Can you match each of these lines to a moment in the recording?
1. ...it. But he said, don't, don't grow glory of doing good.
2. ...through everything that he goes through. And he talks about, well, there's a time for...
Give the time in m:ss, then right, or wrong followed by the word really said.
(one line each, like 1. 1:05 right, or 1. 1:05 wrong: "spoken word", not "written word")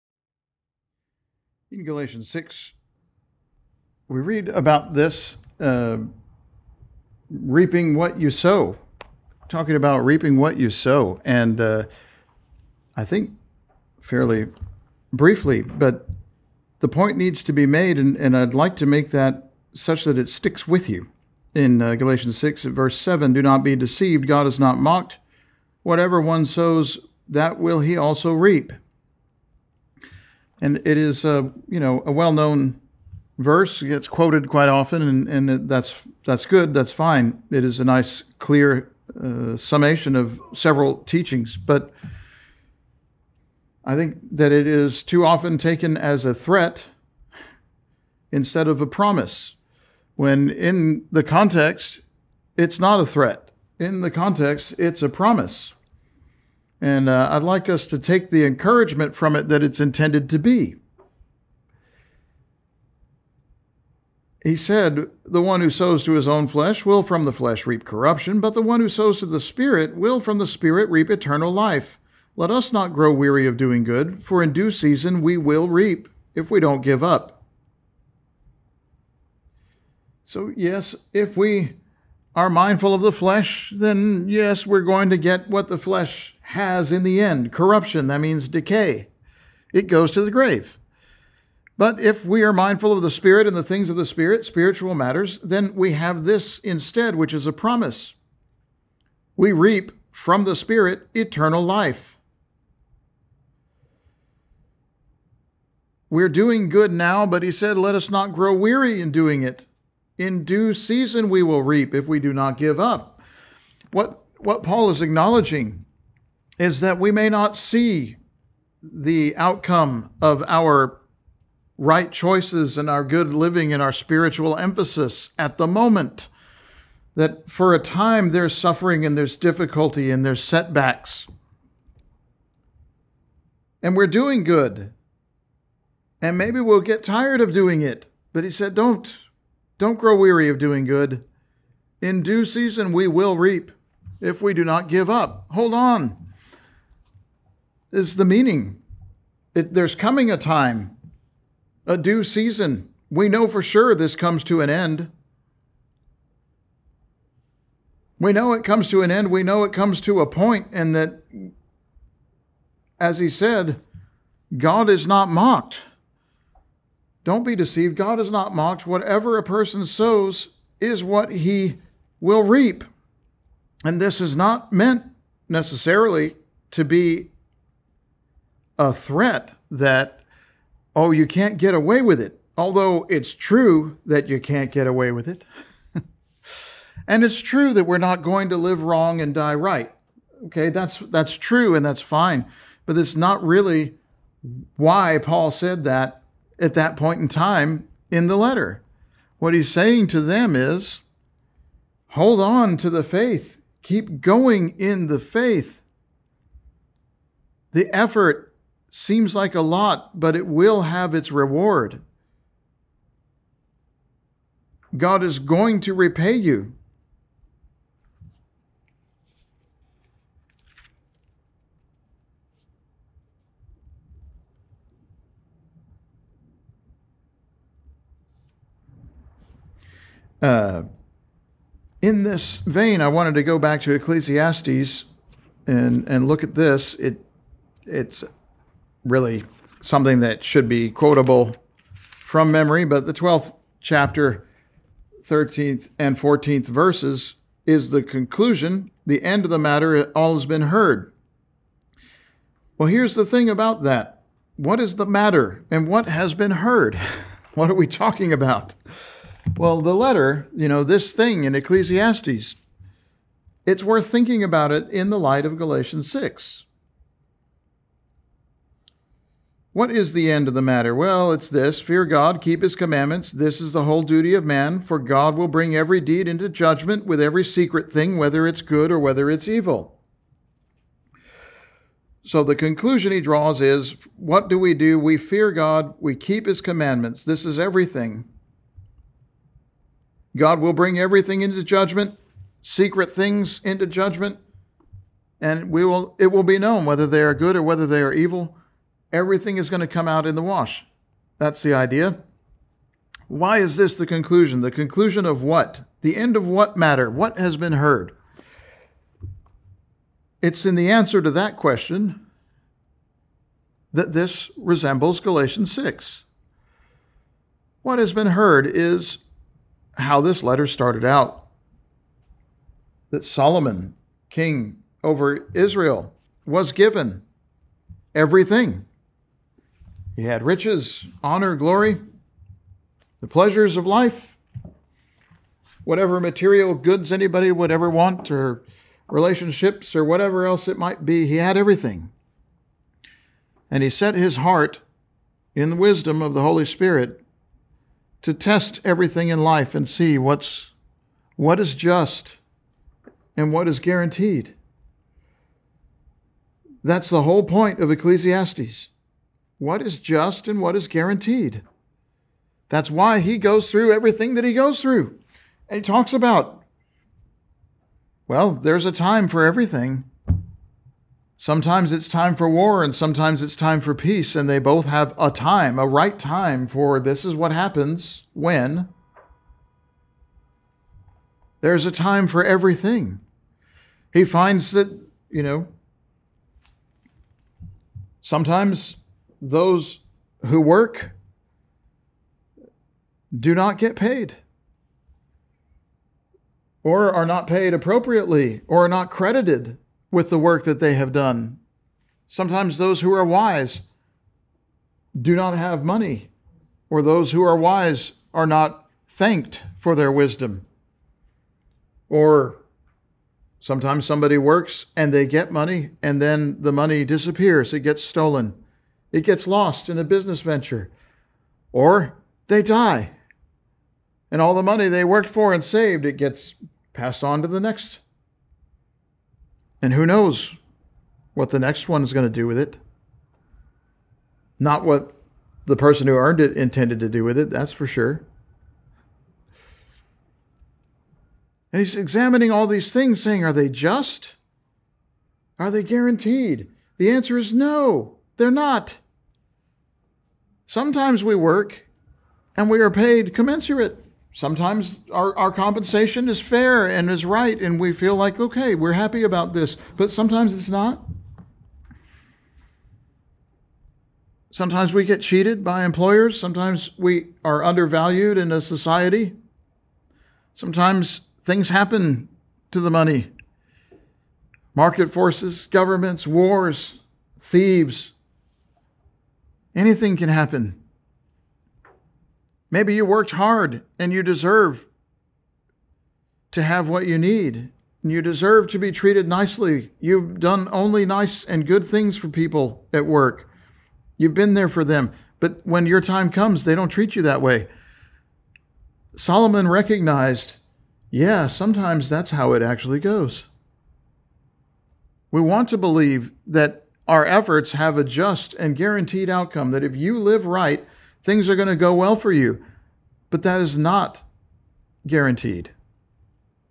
1. 2:17 wrong: "weary", not "glory"
2. 6:03 right.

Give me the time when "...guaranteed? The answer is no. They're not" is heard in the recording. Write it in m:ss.
7:25.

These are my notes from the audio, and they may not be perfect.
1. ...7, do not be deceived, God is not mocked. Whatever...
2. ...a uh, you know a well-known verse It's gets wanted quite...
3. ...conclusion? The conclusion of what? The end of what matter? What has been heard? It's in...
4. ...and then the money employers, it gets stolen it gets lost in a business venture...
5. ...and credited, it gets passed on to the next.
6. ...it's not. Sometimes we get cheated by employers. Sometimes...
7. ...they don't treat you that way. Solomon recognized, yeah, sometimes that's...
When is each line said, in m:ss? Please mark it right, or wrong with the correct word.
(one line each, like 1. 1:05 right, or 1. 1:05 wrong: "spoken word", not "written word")
1. 0:22 right
2. 0:31 wrong: "quoted", not "wanted"
3. 5:04 right
4. 6:56 wrong: "disappears", not "employers"
5. 7:05 wrong: "saved", not "credited"
6. 7:40 right
7. 8:16 right.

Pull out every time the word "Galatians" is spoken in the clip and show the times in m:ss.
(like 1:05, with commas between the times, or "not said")
0:01, 0:21, 4:25, 5:15.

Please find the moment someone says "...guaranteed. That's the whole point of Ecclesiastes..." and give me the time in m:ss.
5:53.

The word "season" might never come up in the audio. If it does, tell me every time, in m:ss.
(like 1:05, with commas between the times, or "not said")
1:14, 1:50, 2:22, 2:32.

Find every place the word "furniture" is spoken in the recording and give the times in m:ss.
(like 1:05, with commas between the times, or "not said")
not said.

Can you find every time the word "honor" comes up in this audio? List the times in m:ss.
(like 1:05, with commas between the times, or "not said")
5:31.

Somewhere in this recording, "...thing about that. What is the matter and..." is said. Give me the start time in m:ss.
4:13.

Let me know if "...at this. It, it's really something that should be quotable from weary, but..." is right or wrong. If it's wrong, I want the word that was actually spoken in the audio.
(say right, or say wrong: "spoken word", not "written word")
wrong: "memory", not "weary".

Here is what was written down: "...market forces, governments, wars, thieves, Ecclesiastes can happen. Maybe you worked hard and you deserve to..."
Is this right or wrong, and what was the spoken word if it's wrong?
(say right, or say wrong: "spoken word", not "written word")
wrong: "Anything", not "Ecclesiastes".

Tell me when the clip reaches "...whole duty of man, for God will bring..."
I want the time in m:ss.
4:33.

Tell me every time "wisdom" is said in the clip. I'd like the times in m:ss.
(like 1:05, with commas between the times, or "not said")
5:45, 6:50.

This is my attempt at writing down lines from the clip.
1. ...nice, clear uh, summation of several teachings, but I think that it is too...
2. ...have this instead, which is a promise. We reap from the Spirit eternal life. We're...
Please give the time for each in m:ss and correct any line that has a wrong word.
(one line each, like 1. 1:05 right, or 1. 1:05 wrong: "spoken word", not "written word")
1. 0:37 right
2. 1:35 right.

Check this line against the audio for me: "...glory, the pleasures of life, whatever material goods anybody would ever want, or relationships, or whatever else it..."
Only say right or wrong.
right.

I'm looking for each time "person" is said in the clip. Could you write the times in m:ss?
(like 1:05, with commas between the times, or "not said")
2:49, 7:15.